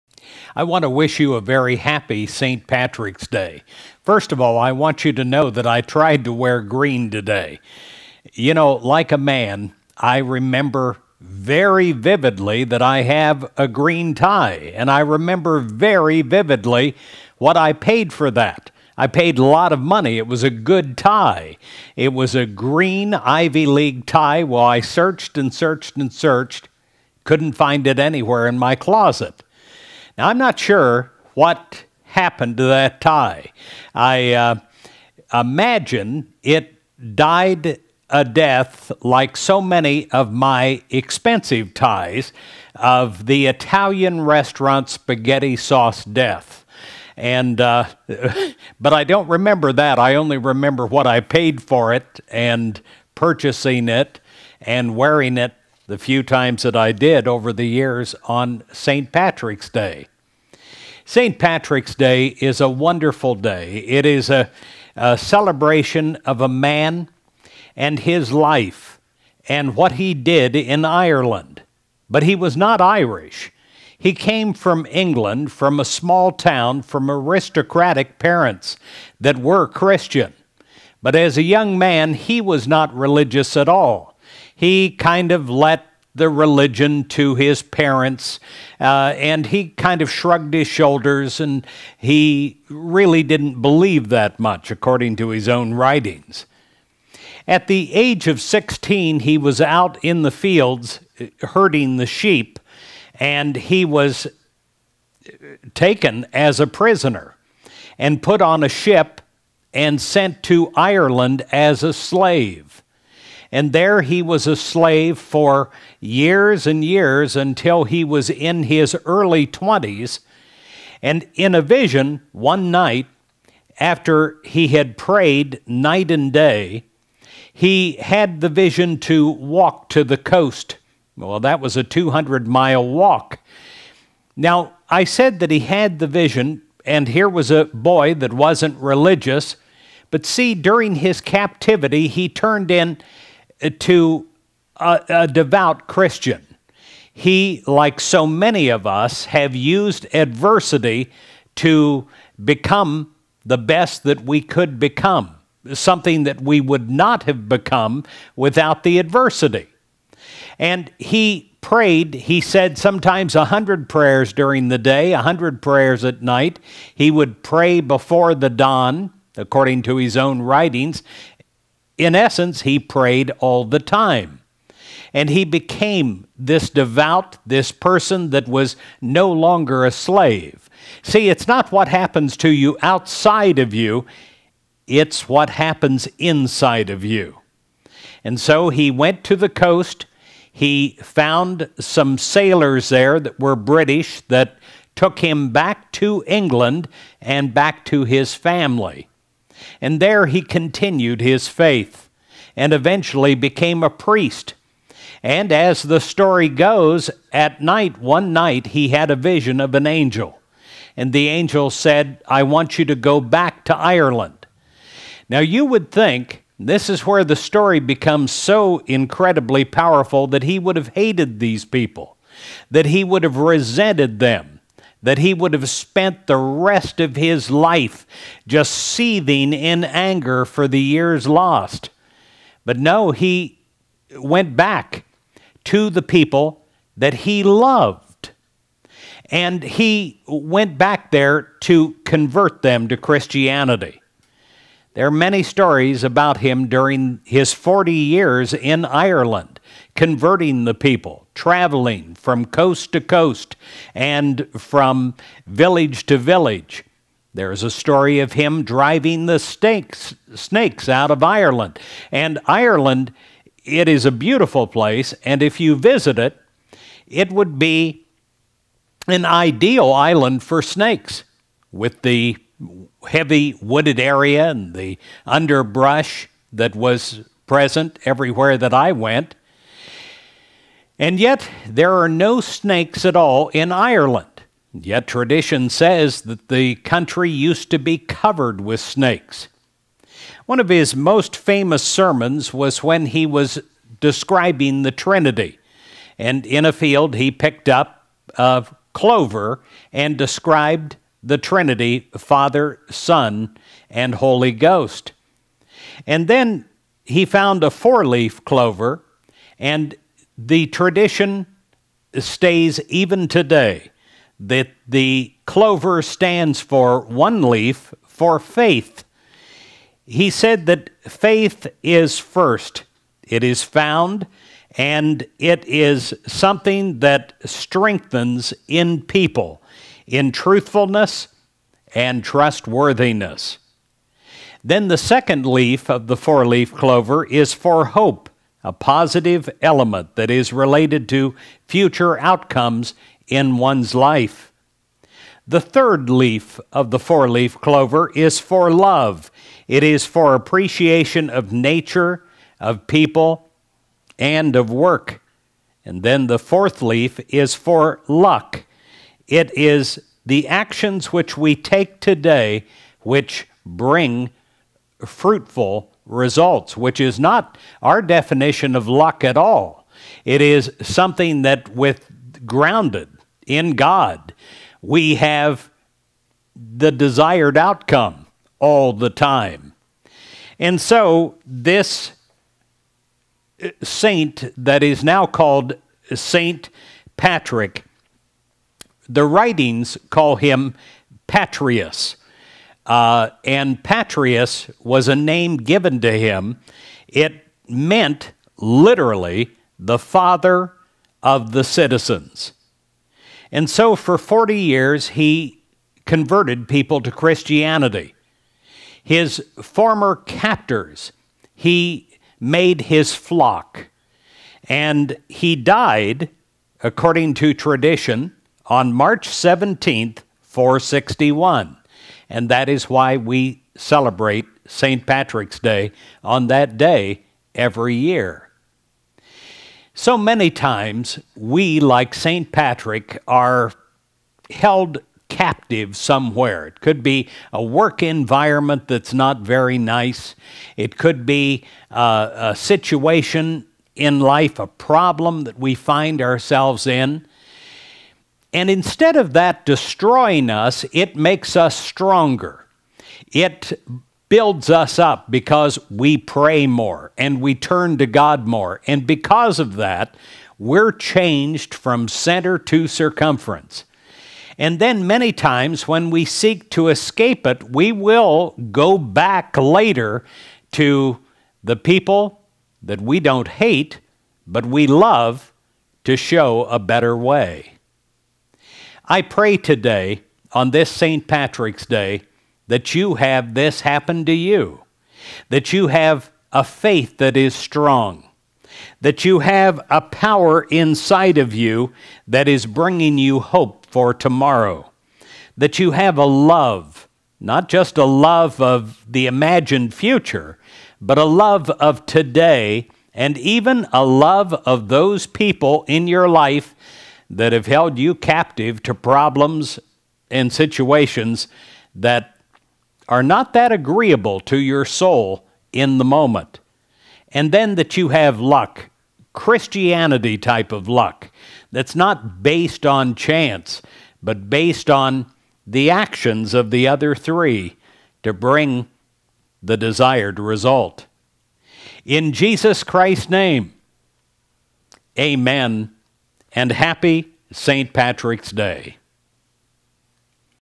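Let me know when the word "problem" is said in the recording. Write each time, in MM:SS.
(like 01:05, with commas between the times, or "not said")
07:24, 08:28.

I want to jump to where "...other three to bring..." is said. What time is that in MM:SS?
08:46.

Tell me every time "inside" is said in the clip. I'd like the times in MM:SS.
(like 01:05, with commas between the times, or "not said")
03:06, 08:10.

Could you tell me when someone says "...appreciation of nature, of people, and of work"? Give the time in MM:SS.
05:50.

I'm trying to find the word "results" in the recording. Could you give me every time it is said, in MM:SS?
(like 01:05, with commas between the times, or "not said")
06:06, 08:50.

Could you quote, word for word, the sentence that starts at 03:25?
And as the story goes, at night, one night, he had a vision of an angel.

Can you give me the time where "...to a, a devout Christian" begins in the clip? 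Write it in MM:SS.
02:23.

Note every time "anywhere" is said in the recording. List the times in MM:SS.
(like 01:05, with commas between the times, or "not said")
00:27.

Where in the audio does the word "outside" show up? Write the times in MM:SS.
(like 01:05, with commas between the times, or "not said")
03:02.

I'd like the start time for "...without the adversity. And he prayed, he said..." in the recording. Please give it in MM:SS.
02:38.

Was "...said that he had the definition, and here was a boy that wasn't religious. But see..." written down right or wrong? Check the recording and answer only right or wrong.
wrong.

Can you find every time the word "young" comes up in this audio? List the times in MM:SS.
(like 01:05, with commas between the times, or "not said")
01:21.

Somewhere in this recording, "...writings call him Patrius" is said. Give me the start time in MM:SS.
06:29.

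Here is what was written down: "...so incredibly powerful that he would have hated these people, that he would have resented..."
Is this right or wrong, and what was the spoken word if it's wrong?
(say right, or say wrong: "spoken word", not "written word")
right.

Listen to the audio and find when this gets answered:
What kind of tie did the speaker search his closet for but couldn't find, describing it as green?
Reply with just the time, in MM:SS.
00:23.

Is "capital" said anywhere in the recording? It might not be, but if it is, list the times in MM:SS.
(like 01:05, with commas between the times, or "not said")
not said.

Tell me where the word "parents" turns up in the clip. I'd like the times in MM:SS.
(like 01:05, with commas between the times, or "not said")
01:18, 01:27.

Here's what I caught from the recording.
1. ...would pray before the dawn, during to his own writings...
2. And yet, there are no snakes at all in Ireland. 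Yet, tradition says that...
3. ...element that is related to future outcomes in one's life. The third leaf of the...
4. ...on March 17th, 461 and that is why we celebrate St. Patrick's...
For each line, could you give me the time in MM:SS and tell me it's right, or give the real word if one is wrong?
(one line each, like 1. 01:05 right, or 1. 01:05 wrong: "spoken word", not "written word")
1. 02:47 wrong: "according", not "during"
2. 04:41 right
3. 05:39 right
4. 06:58 right.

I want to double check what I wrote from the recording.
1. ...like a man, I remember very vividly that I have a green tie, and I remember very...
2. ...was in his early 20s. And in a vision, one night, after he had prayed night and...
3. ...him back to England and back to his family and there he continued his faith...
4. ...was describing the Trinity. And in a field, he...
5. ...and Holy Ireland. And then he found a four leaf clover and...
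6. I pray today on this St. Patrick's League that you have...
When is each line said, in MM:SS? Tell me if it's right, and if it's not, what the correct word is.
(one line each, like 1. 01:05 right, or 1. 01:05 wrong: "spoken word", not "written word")
1. 00:08 right
2. 01:58 right
3. 03:15 right
4. 04:53 right
5. 05:03 wrong: "Ghost", not "Ireland"
6. 07:59 wrong: "Day", not "League".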